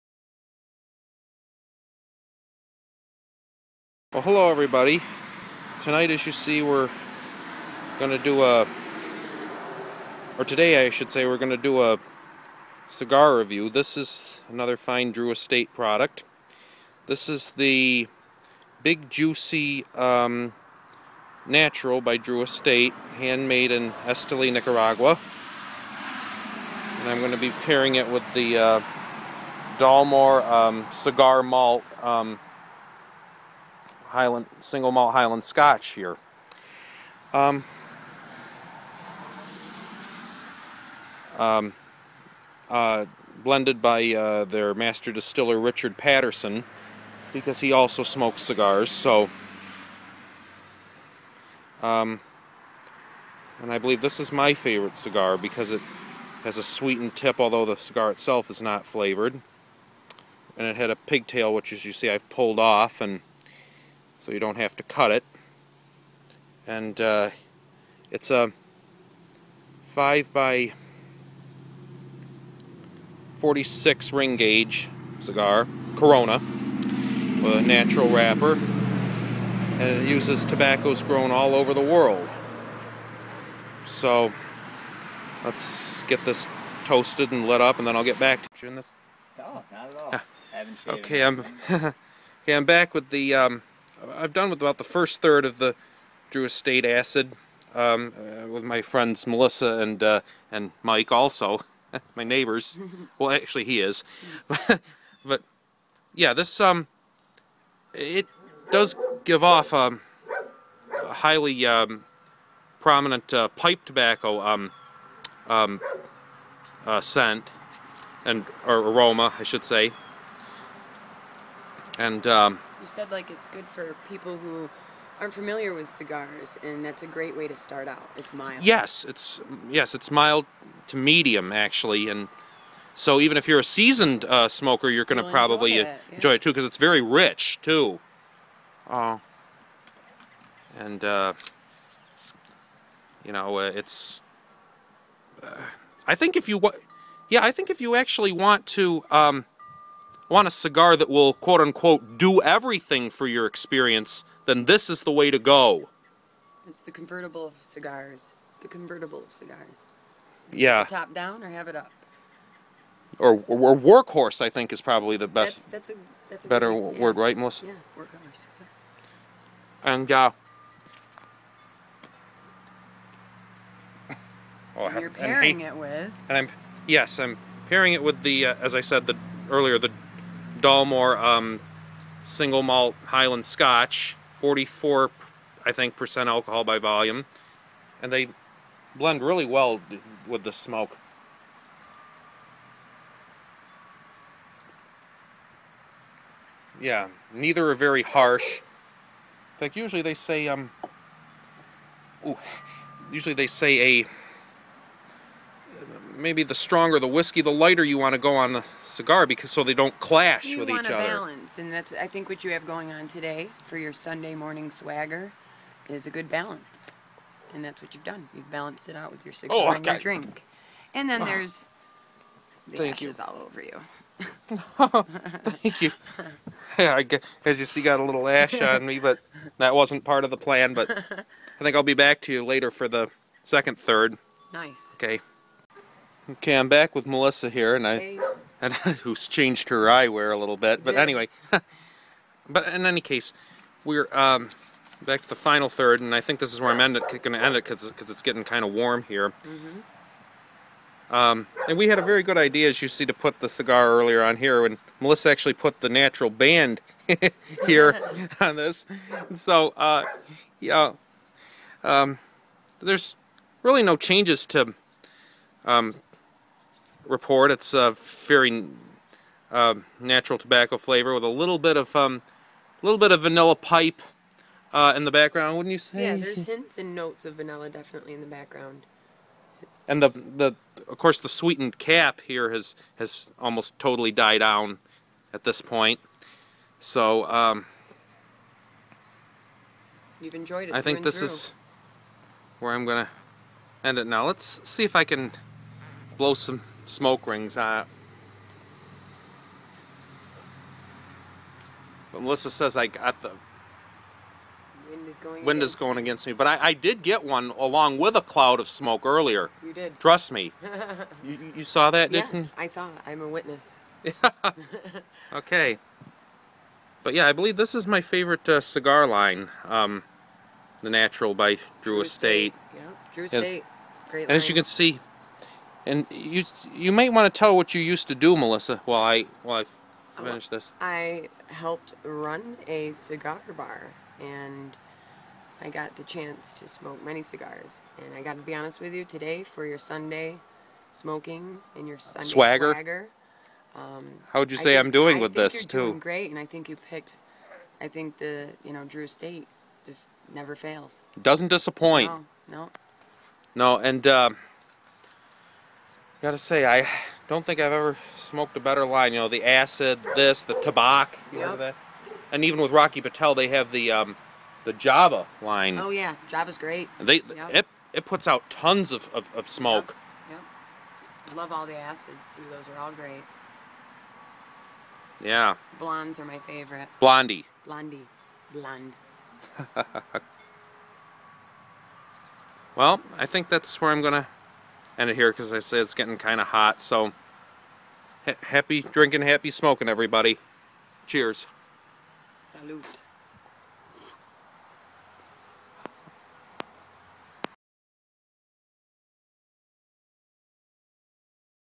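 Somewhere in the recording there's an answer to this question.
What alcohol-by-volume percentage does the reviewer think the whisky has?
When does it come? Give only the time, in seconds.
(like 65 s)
184 s.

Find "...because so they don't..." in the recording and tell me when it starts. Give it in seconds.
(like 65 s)
209 s.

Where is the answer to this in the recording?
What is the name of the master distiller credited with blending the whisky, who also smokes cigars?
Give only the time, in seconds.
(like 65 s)
45 s.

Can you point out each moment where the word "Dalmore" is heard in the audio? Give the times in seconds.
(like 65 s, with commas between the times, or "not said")
29 s, 180 s.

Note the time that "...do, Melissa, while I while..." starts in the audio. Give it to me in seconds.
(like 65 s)
328 s.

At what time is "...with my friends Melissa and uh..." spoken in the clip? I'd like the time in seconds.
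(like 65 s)
98 s.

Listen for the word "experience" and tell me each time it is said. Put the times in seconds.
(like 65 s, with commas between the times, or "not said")
153 s.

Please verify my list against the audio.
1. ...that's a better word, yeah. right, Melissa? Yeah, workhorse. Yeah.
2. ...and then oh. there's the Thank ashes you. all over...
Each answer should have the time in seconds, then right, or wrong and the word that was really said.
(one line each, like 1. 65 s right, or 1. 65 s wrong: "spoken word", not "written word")
1. 166 s right
2. 220 s right.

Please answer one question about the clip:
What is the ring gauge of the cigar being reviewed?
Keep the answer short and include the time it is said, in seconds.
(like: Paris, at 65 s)
46, at 73 s.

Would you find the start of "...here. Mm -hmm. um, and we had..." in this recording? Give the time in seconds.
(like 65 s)
249 s.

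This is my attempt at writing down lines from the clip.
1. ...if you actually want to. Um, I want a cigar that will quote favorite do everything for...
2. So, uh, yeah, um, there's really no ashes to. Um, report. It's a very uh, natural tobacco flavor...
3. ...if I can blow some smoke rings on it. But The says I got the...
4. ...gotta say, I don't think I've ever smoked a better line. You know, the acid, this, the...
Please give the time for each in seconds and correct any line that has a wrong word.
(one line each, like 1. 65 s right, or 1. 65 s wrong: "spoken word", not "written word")
1. 147 s wrong: "unquote", not "favorite"
2. 259 s wrong: "changes", not "ashes"
3. 294 s wrong: "Melissa", not "The"
4. 356 s right.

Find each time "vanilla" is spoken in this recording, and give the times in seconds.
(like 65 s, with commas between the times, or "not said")
273 s, 277 s.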